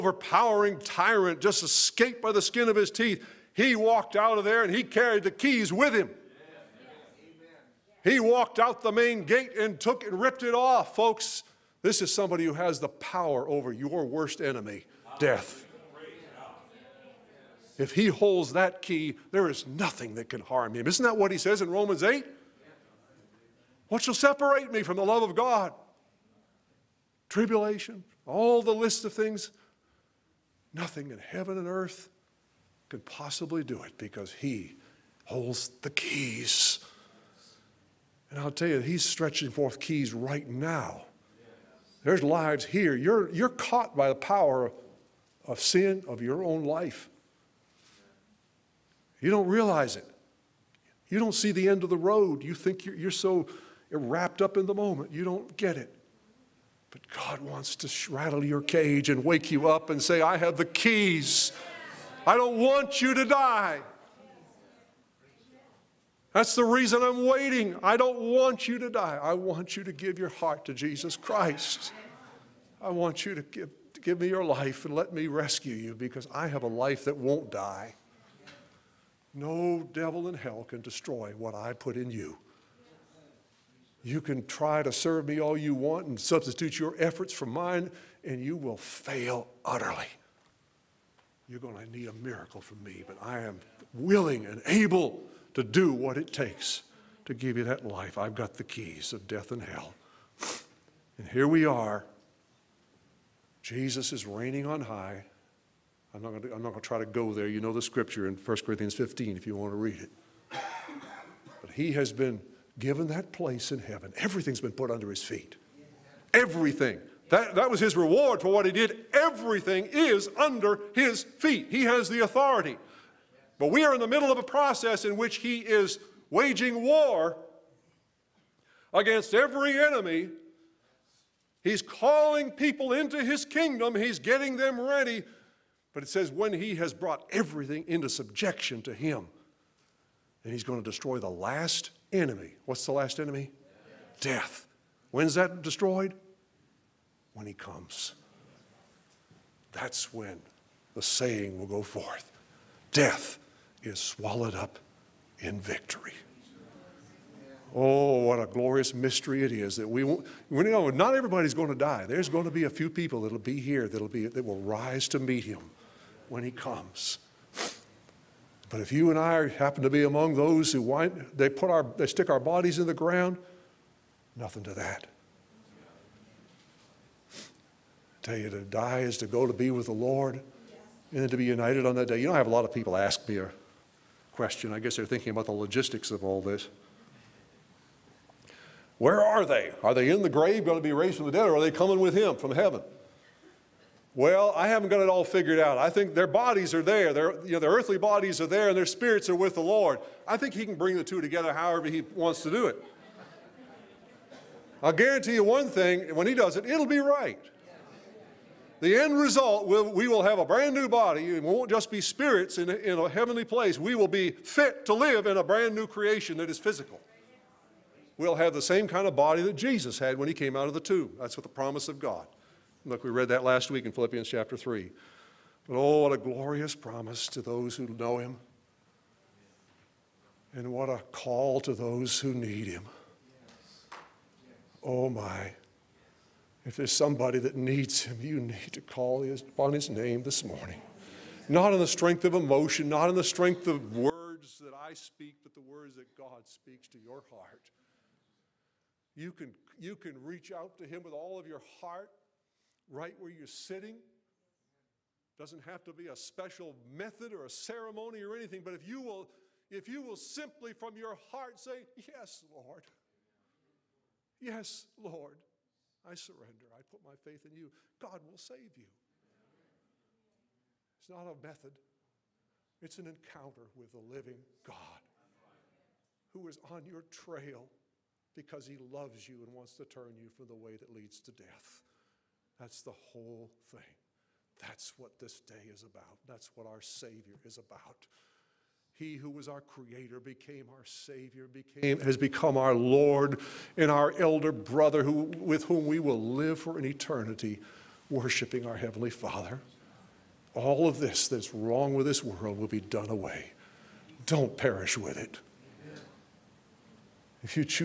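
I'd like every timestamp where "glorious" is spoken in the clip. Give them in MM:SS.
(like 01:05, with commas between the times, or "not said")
02:38, 03:46.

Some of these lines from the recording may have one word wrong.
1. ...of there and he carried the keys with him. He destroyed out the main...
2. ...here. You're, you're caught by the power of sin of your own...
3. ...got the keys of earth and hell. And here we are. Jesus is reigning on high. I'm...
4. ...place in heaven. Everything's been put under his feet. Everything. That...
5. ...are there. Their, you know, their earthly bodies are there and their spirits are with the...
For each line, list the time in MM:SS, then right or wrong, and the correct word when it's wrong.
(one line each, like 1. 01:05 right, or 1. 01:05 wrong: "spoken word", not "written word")
1. 00:04 wrong: "walked", not "destroyed"
2. 00:42 right
3. 01:38 wrong: "death", not "earth"
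4. 01:53 right
5. 03:16 right.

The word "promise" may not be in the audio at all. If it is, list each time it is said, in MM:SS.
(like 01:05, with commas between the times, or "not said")
03:41, 03:46.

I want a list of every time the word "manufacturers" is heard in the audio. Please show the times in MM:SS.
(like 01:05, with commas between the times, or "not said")
not said.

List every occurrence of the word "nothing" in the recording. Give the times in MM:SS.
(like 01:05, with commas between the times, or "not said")
00:19, 00:30, 02:54.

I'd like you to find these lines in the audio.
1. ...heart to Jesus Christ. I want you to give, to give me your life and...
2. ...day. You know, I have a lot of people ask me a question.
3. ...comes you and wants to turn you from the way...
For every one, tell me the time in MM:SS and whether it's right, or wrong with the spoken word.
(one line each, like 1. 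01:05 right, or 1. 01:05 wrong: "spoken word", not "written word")
1. 01:10 right
2. 03:02 right
3. 04:38 wrong: "loves", not "comes".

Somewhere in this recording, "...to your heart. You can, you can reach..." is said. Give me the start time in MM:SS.
04:06.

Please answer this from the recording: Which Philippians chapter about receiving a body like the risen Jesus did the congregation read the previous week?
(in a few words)
Philippians chapter 3.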